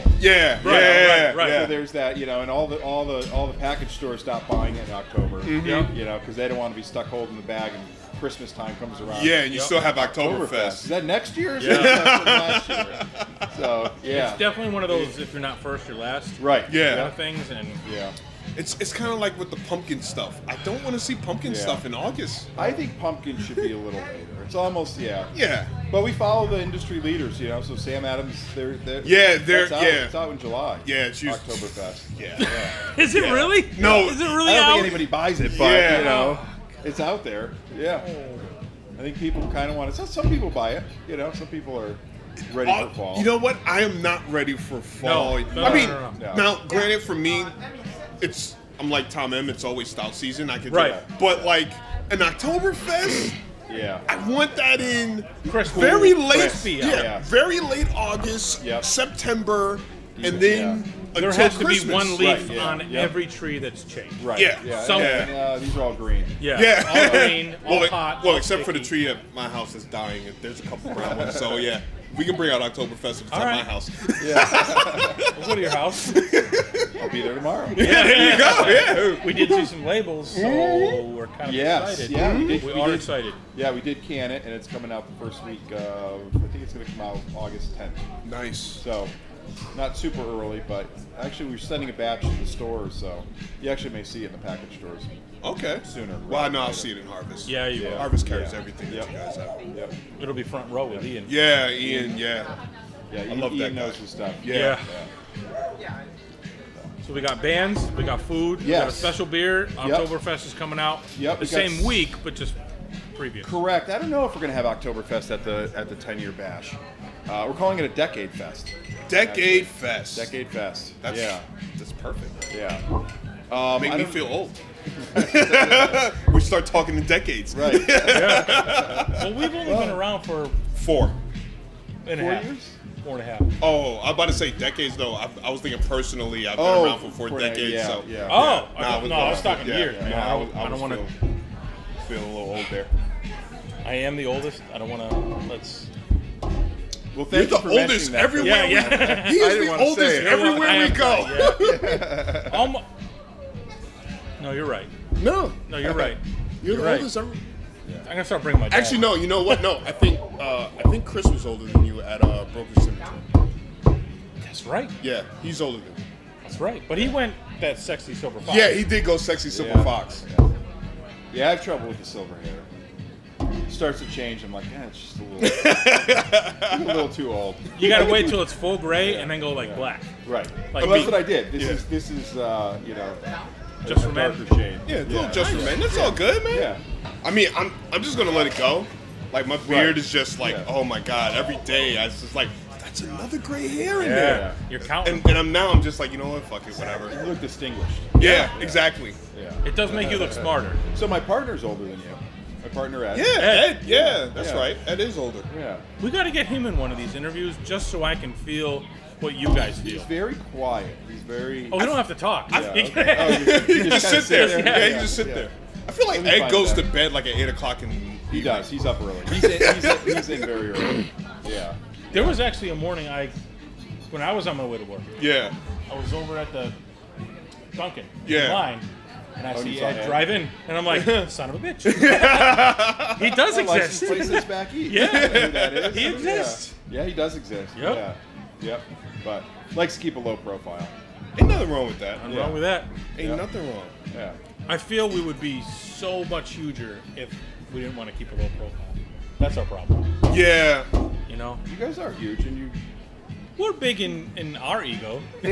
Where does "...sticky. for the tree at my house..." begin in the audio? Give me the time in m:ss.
1:08.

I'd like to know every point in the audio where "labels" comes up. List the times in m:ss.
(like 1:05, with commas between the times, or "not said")
1:19.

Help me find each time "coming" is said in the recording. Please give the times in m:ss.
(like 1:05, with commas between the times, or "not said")
1:24, 1:50.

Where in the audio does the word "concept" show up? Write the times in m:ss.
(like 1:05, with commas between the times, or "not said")
not said.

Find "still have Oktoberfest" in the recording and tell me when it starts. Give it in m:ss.
0:09.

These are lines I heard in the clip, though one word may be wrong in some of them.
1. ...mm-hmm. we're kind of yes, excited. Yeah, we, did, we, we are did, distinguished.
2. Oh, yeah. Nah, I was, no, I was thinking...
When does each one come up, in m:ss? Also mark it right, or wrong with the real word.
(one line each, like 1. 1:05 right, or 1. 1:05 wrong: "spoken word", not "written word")
1. 1:20 wrong: "excited", not "distinguished"
2. 2:18 wrong: "talking", not "thinking".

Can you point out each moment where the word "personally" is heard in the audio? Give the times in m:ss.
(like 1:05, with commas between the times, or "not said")
2:15.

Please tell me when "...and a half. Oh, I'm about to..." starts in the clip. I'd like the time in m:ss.
2:13.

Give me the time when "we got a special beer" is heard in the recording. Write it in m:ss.
1:48.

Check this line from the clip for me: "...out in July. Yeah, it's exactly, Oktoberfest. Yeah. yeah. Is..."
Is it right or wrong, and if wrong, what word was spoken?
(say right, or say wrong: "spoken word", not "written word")
wrong: "usually", not "exactly".